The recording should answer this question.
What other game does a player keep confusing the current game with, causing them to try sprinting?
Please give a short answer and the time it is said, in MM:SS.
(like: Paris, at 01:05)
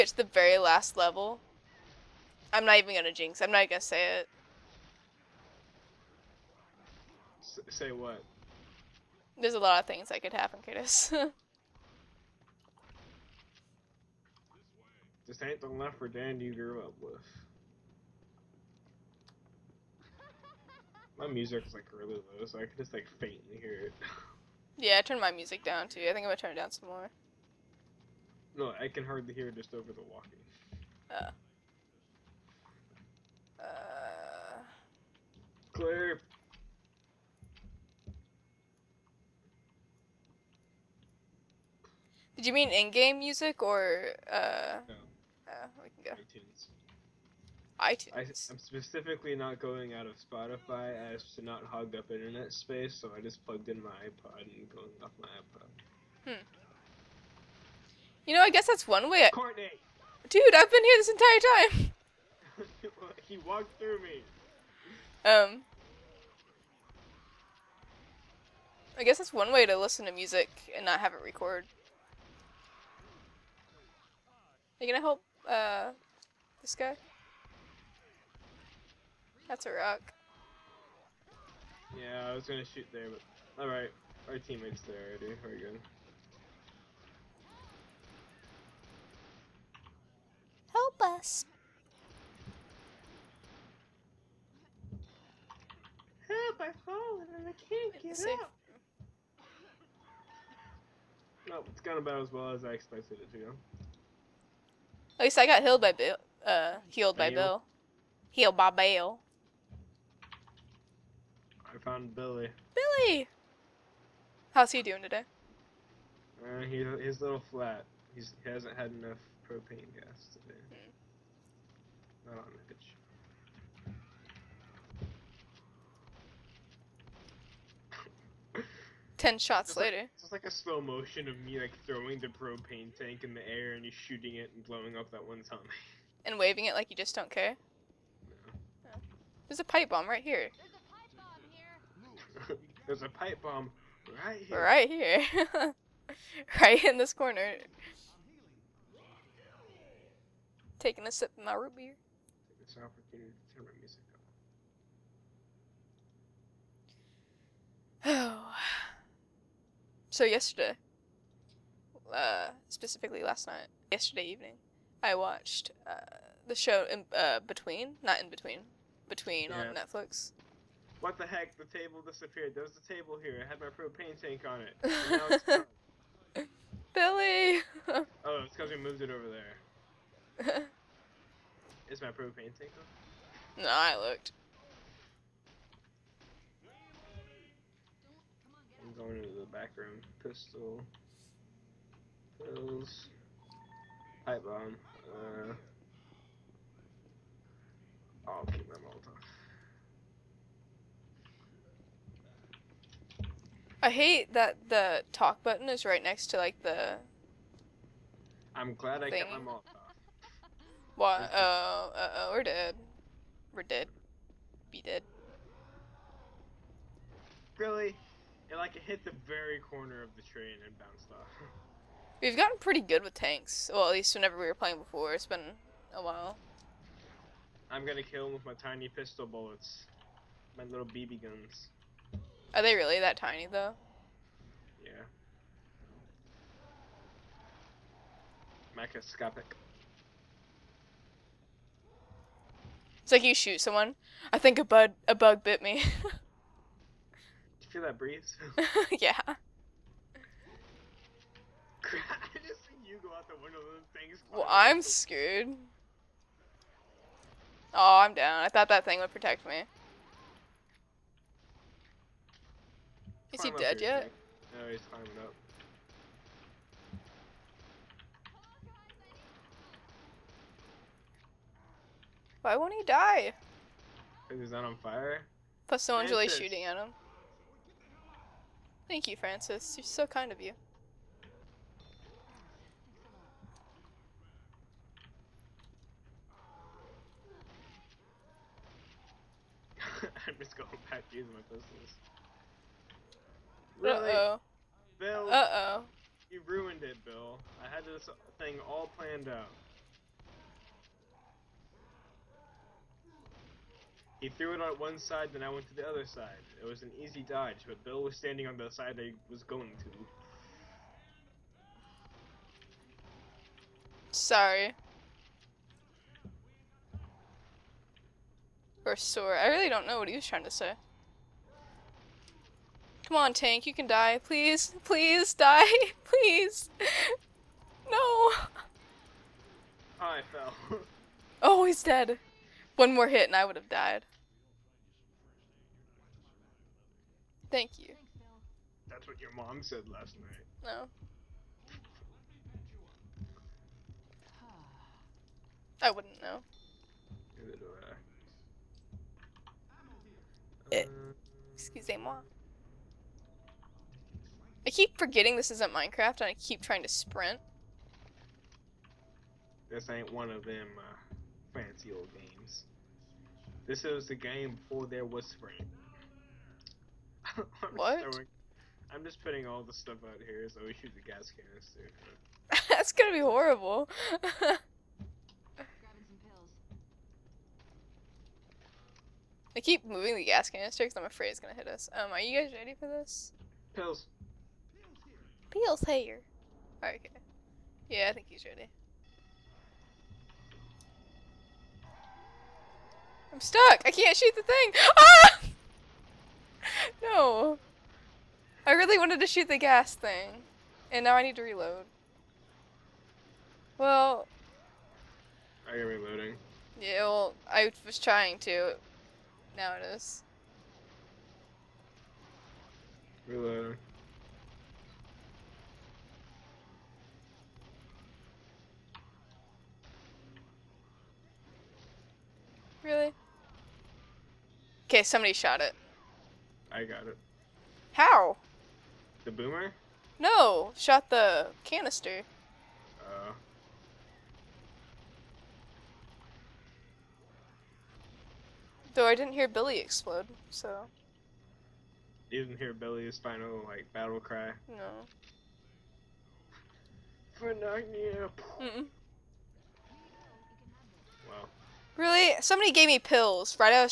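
Minecraft, at 05:55.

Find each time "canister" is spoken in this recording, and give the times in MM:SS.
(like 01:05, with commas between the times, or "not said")
06:11, 06:20, 07:11.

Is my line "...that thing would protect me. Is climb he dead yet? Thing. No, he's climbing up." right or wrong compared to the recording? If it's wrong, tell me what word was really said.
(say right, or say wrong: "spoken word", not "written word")
right.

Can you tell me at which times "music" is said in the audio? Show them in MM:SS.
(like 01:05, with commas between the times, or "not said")
00:21, 00:25, 00:43, 01:10, 02:33.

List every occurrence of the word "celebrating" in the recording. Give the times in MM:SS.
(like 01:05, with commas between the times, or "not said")
not said.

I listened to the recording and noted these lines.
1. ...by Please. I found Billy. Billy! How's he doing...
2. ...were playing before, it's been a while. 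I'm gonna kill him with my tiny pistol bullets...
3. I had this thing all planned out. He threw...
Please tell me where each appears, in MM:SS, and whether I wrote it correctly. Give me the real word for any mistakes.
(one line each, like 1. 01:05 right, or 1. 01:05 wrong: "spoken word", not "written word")
1. 01:48 wrong: "Bill", not "Please"
2. 03:44 right
3. 04:57 right.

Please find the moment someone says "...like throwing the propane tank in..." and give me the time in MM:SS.
02:11.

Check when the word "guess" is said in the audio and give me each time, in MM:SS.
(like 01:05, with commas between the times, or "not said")
00:58, 01:09.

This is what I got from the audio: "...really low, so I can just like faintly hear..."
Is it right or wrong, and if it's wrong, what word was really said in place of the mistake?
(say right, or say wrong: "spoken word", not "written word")
right.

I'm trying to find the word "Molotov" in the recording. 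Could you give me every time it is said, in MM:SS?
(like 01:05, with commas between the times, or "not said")
03:18, 03:29.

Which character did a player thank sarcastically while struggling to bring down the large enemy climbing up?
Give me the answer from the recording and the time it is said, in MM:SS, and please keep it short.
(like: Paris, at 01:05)
Francis, at 04:39.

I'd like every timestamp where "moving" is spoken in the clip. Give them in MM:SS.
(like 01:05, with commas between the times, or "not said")
06:19.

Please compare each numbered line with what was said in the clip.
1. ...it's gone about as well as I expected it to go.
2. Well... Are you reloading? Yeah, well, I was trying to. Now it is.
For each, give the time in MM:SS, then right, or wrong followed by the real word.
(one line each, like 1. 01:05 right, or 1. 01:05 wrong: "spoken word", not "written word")
1. 01:41 right
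2. 06:43 right.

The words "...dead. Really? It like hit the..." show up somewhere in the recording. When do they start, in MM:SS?
03:34.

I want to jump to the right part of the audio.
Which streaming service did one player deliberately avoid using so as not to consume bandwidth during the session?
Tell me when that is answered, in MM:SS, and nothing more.
00:50.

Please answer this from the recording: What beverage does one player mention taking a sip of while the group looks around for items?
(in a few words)
Root beer.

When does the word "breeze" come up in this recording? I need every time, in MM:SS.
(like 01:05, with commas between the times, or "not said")
04:07.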